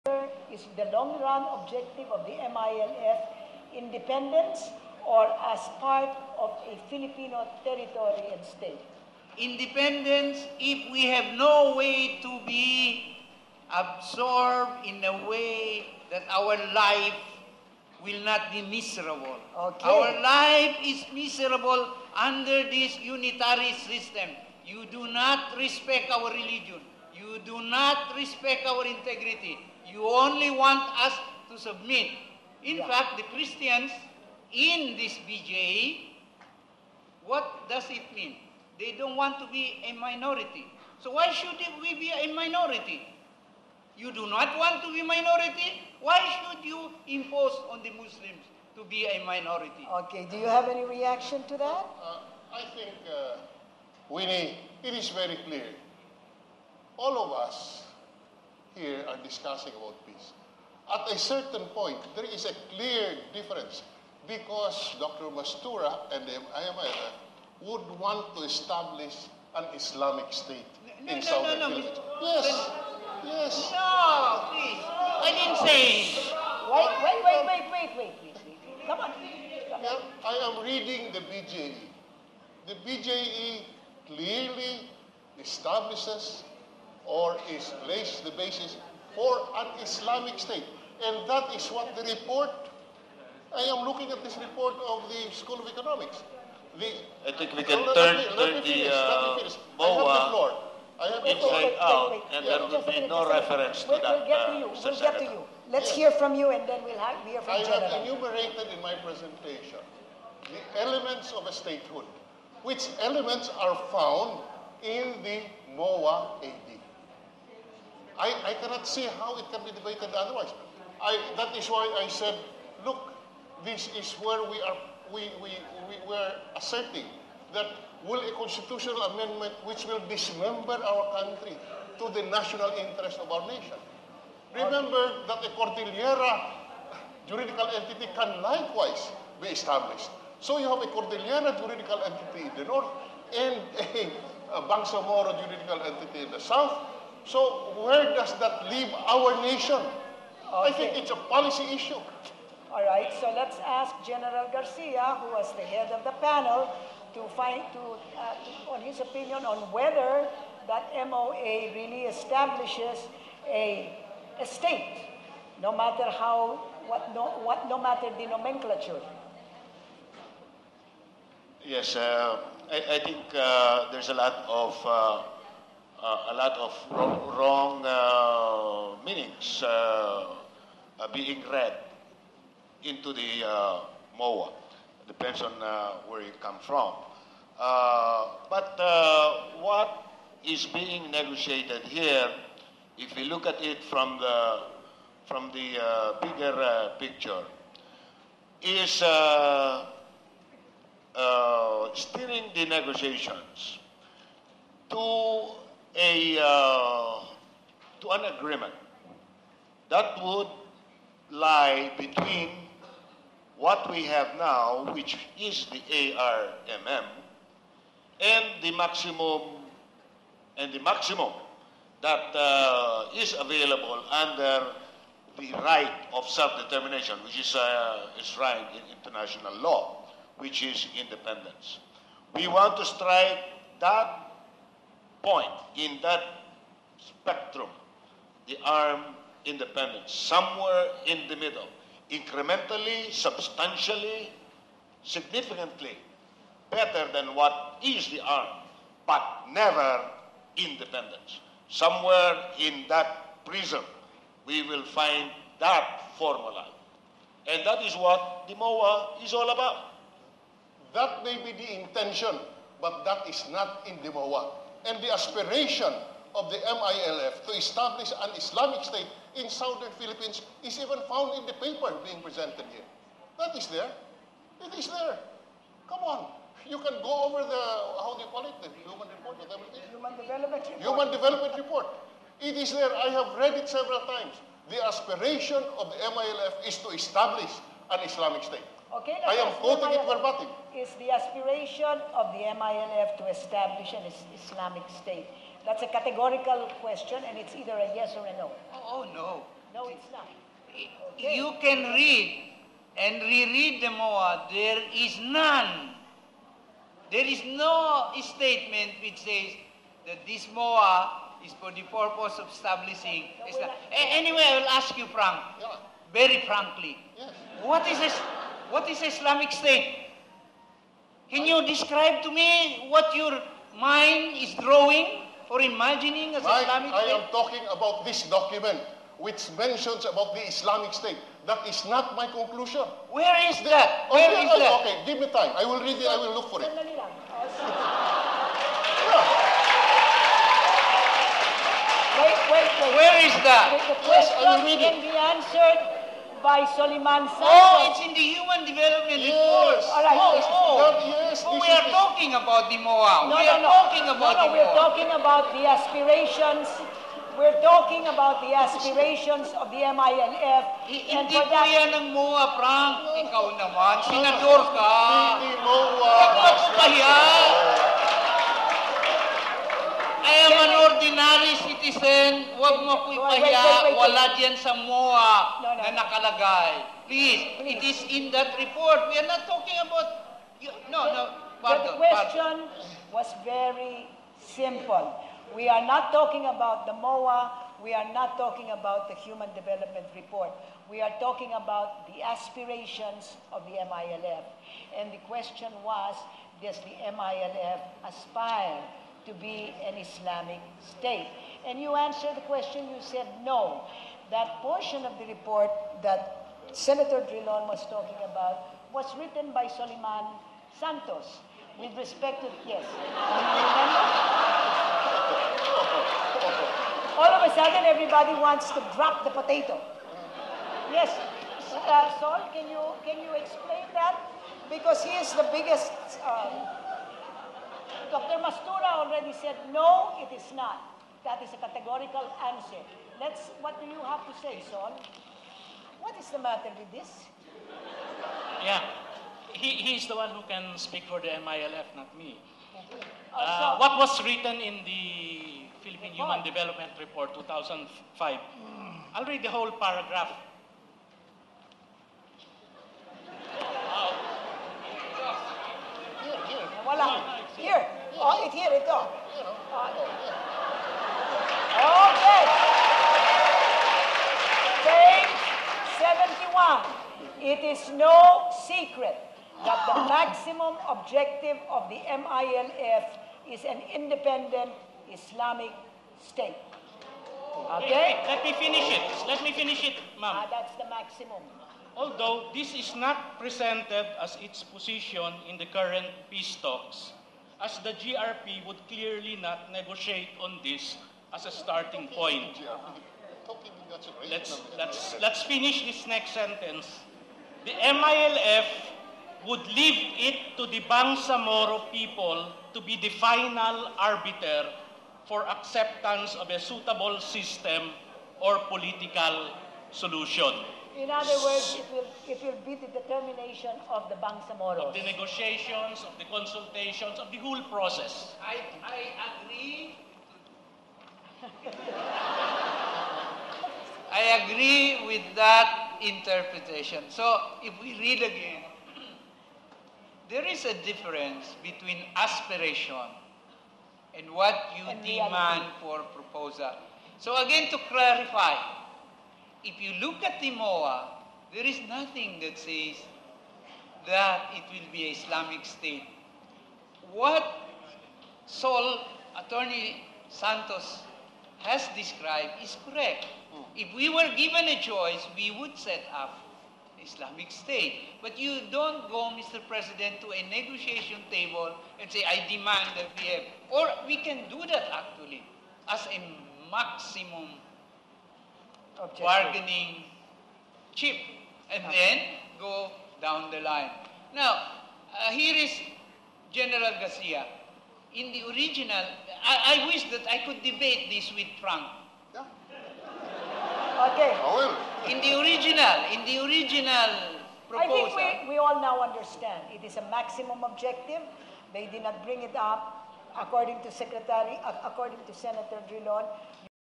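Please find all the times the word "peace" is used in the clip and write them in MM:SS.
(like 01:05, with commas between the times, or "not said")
01:00, 08:06.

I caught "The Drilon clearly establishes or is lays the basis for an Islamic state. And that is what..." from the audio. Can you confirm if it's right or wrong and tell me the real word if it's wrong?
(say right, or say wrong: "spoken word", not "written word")
wrong: "BJE", not "Drilon".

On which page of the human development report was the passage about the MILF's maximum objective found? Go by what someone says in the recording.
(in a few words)
71.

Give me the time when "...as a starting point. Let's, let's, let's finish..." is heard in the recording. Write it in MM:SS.
08:11.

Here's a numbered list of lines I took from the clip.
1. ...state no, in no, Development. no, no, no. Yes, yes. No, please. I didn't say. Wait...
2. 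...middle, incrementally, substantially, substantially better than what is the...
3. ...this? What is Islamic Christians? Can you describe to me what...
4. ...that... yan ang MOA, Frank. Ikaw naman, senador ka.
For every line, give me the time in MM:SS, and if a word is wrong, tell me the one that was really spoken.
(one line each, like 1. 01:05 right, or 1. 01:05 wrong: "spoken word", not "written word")
1. 01:10 wrong: "Arabia", not "Development"
2. 04:01 wrong: "significantly", not "substantially"
3. 05:17 wrong: "State", not "Christians"
4. 06:01 right.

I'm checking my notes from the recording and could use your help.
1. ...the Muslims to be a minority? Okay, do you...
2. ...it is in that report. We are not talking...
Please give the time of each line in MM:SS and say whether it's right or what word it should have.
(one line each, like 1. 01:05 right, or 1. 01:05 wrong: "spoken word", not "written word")
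1. 00:47 right
2. 06:17 right.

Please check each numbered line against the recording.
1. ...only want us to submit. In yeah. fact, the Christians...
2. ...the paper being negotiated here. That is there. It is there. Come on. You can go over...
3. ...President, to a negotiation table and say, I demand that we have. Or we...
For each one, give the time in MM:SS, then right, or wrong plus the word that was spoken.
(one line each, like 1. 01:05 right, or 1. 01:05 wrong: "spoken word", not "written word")
1. 00:30 right
2. 04:31 wrong: "presented", not "negotiated"
3. 09:19 right.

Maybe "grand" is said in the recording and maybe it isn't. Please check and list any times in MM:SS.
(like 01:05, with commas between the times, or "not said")
not said.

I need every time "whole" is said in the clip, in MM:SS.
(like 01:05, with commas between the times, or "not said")
07:29, 08:37.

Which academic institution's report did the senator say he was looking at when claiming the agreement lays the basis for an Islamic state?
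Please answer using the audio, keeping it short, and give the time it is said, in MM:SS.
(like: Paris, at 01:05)
School of Economics, at 01:35.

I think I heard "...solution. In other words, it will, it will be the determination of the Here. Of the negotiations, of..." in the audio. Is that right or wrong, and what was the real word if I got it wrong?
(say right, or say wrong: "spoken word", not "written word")
wrong: "Bangsamoros", not "Here".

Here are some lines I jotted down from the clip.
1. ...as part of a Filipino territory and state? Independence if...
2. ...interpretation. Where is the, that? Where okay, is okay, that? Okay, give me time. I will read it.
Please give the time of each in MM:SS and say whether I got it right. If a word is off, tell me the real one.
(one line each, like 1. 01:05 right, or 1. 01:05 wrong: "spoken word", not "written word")
1. 00:05 right
2. 05:32 wrong: "conclusion", not "interpretation".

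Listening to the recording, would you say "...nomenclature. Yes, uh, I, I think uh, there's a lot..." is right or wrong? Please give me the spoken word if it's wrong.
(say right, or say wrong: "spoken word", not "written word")
right.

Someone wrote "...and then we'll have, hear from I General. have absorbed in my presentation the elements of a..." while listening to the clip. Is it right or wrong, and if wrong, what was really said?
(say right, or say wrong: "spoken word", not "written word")
wrong: "enumerated", not "absorbed".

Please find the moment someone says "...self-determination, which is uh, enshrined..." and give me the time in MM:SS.
03:46.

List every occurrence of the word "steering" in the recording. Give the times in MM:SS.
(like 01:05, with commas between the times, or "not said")
03:21.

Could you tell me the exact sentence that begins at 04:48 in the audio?
Okay, I am quoting it verbatim.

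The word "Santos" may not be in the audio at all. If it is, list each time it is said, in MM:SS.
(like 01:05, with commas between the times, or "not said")
06:50, 09:10.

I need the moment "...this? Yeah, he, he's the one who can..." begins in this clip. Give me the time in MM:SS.
07:16.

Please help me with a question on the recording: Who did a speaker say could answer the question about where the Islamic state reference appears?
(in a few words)
Soliman Sanchez.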